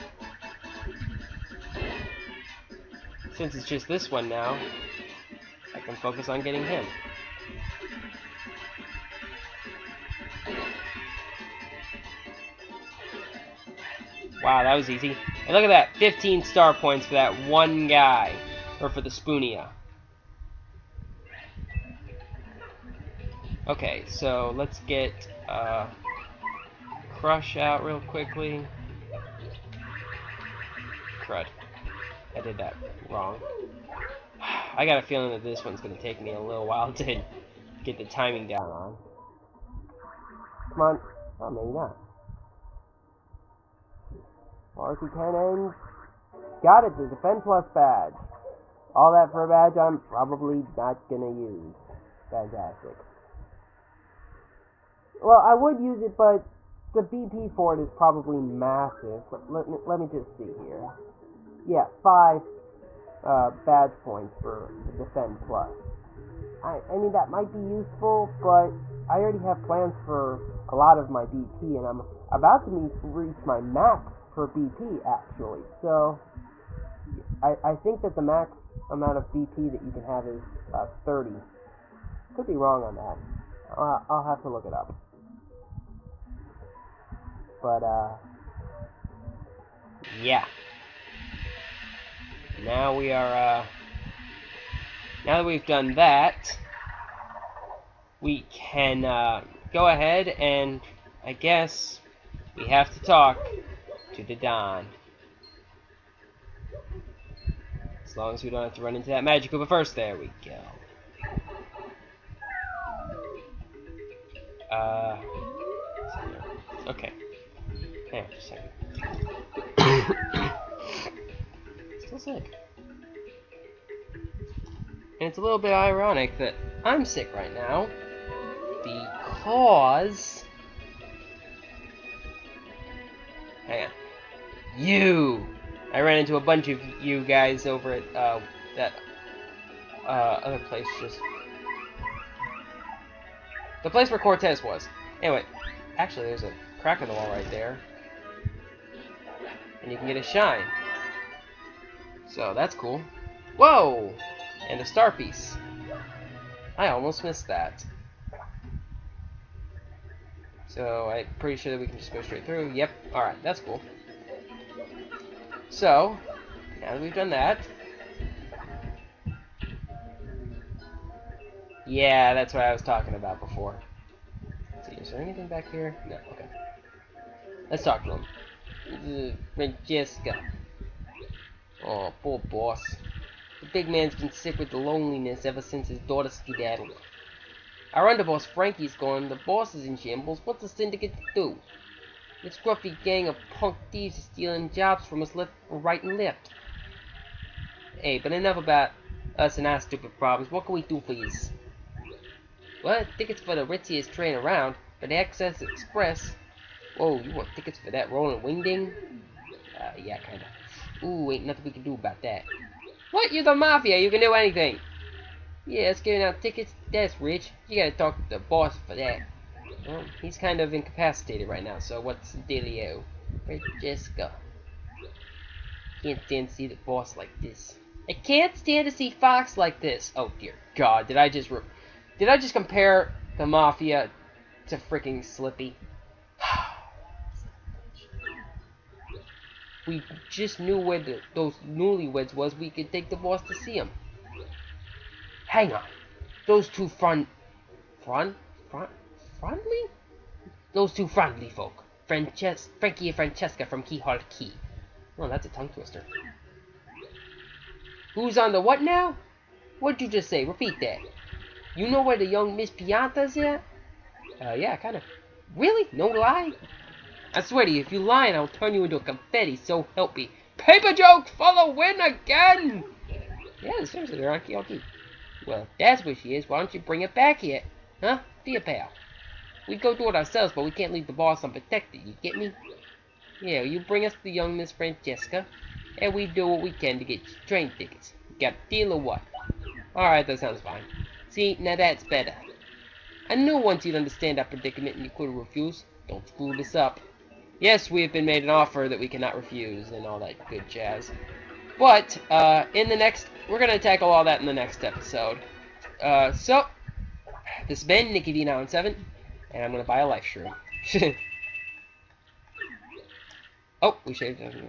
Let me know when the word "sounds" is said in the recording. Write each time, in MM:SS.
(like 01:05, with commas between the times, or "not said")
04:50.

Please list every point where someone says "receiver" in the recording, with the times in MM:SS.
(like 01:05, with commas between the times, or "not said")
not said.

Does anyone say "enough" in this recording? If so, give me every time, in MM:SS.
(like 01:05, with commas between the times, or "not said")
03:18.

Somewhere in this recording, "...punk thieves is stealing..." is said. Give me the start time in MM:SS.
03:13.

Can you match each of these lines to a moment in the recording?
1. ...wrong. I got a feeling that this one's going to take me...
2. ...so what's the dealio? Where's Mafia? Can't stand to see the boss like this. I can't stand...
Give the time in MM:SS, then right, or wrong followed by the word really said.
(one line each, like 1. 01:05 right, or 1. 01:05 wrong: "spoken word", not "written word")
1. 00:33 right
2. 03:41 wrong: "Jessica", not "Mafia".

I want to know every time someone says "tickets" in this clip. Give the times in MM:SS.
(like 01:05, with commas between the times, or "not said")
03:23, 03:27, 03:36, 04:47.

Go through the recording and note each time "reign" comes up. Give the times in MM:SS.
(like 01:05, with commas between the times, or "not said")
not said.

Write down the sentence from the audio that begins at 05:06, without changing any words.
Uh, so, this has been Nikki d oh Seven, and I'm going to buy a life shroom.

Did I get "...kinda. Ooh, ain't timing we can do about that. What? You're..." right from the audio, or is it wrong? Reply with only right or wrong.
wrong.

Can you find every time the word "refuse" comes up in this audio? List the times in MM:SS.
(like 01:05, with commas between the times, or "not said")
04:55, 04:59.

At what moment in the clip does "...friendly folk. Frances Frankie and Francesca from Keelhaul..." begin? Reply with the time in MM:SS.
04:11.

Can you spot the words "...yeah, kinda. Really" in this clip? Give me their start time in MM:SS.
04:24.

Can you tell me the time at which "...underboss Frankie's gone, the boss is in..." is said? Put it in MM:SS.
03:08.